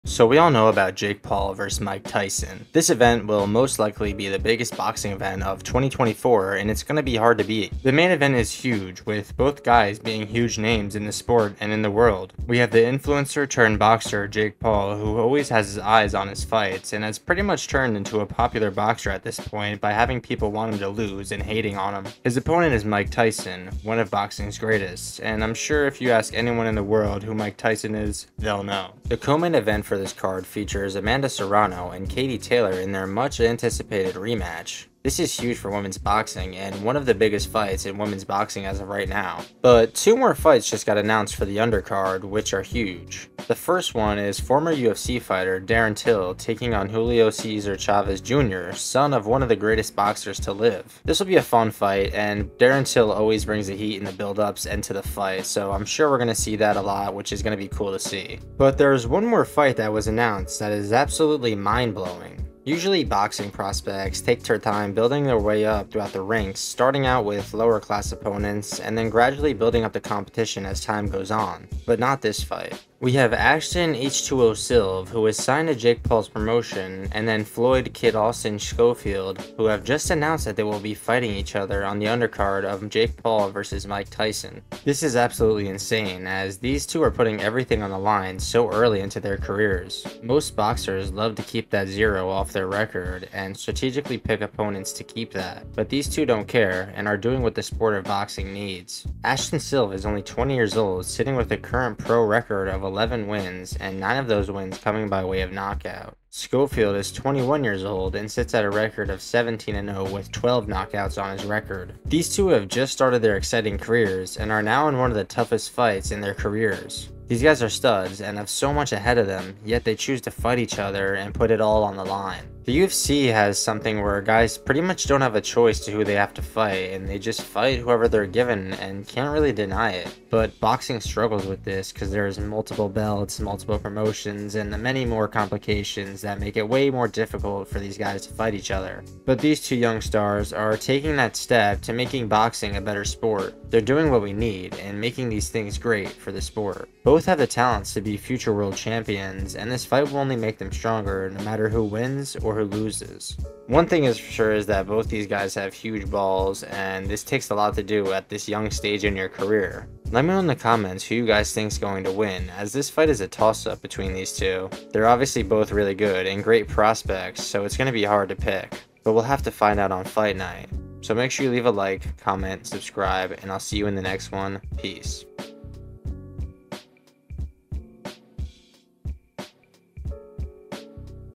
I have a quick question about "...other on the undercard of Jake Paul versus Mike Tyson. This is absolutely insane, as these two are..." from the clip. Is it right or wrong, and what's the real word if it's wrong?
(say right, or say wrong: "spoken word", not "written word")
right.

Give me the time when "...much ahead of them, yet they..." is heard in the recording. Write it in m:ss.
1:58.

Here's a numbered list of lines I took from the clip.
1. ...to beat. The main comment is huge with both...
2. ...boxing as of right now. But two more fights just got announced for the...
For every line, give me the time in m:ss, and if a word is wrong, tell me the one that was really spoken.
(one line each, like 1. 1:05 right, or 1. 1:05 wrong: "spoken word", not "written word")
1. 0:07 wrong: "event", not "comment"
2. 0:38 right.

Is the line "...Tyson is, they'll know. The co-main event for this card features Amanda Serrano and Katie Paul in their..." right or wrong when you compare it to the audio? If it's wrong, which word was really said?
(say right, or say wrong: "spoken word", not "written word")
wrong: "Taylor", not "Paul".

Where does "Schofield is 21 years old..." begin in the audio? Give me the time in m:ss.
1:46.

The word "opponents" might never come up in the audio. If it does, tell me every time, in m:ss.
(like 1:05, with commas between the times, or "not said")
0:22, 1:08, 1:34.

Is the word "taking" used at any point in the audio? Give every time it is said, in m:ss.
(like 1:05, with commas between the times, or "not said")
0:46, 2:20.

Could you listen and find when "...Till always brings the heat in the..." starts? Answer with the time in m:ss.
0:52.